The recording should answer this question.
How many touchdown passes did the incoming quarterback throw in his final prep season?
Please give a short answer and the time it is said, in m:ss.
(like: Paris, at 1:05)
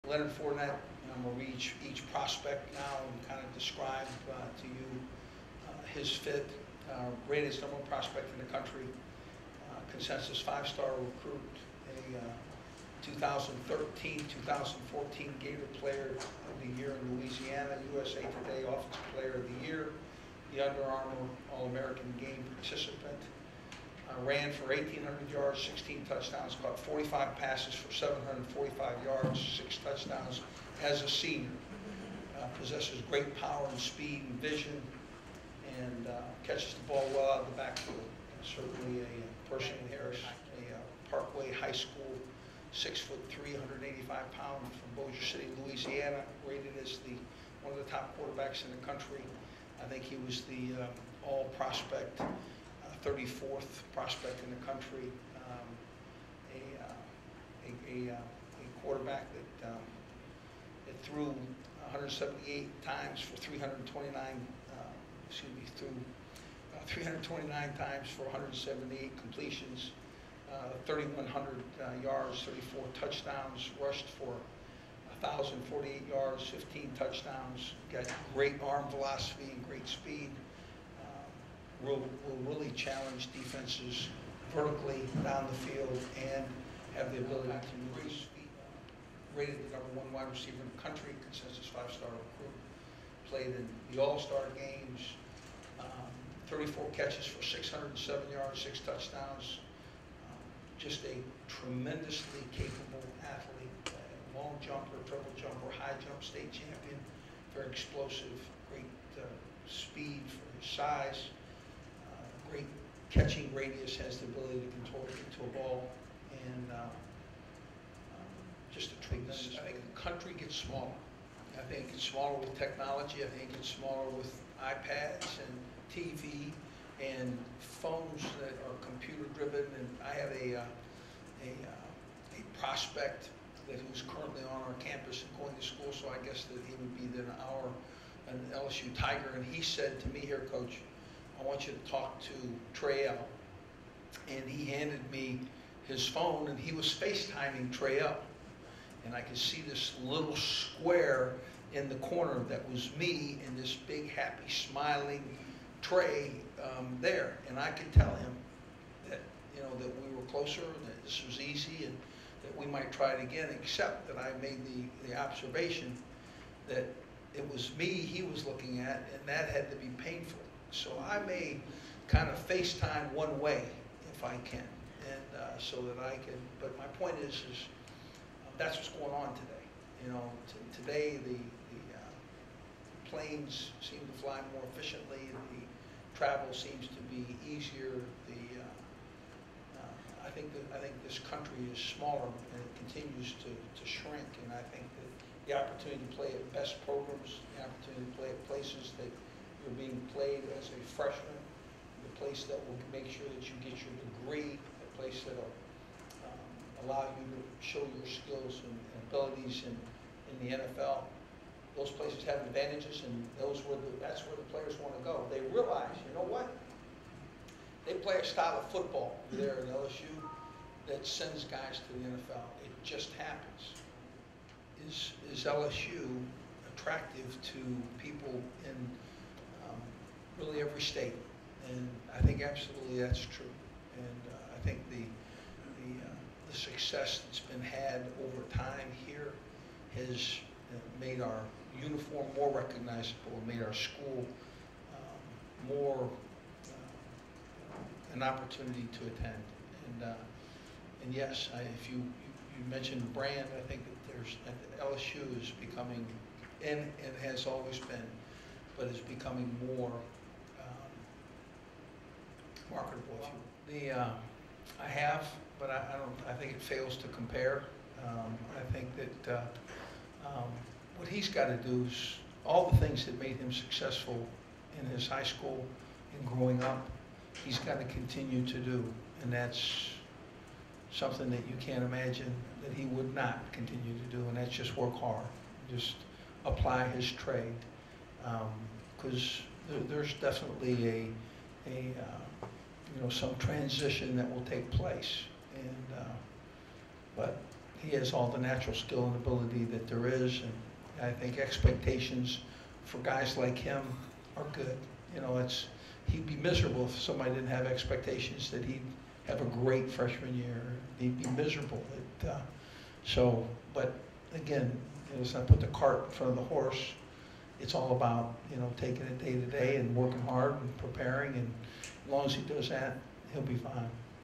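34, at 1:12.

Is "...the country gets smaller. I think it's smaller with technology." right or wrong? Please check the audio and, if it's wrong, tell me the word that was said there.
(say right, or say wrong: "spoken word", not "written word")
right.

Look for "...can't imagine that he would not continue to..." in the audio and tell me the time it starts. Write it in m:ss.
4:41.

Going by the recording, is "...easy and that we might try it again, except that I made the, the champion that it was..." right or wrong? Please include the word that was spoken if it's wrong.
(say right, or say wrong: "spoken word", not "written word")
wrong: "observation", not "champion".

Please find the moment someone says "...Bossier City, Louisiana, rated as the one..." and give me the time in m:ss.
0:45.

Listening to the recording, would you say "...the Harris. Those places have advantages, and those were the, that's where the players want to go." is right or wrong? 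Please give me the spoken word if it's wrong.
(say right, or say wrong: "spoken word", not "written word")
wrong: "NFL", not "Harris".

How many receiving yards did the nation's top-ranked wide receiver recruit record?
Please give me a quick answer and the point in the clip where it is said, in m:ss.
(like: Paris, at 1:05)
607, at 1:37.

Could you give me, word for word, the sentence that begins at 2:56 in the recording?
But my point is, is uh, that's what's going on today.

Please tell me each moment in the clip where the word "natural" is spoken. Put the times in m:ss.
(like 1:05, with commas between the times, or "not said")
4:58.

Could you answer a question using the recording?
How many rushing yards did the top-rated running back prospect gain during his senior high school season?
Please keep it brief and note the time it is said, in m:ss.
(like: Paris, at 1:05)
1,800, at 0:24.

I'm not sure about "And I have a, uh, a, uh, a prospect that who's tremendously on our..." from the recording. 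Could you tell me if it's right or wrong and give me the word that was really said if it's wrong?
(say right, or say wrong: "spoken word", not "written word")
wrong: "currently", not "tremendously".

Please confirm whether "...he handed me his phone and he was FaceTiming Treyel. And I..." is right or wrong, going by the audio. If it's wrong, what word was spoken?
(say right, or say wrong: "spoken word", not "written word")
right.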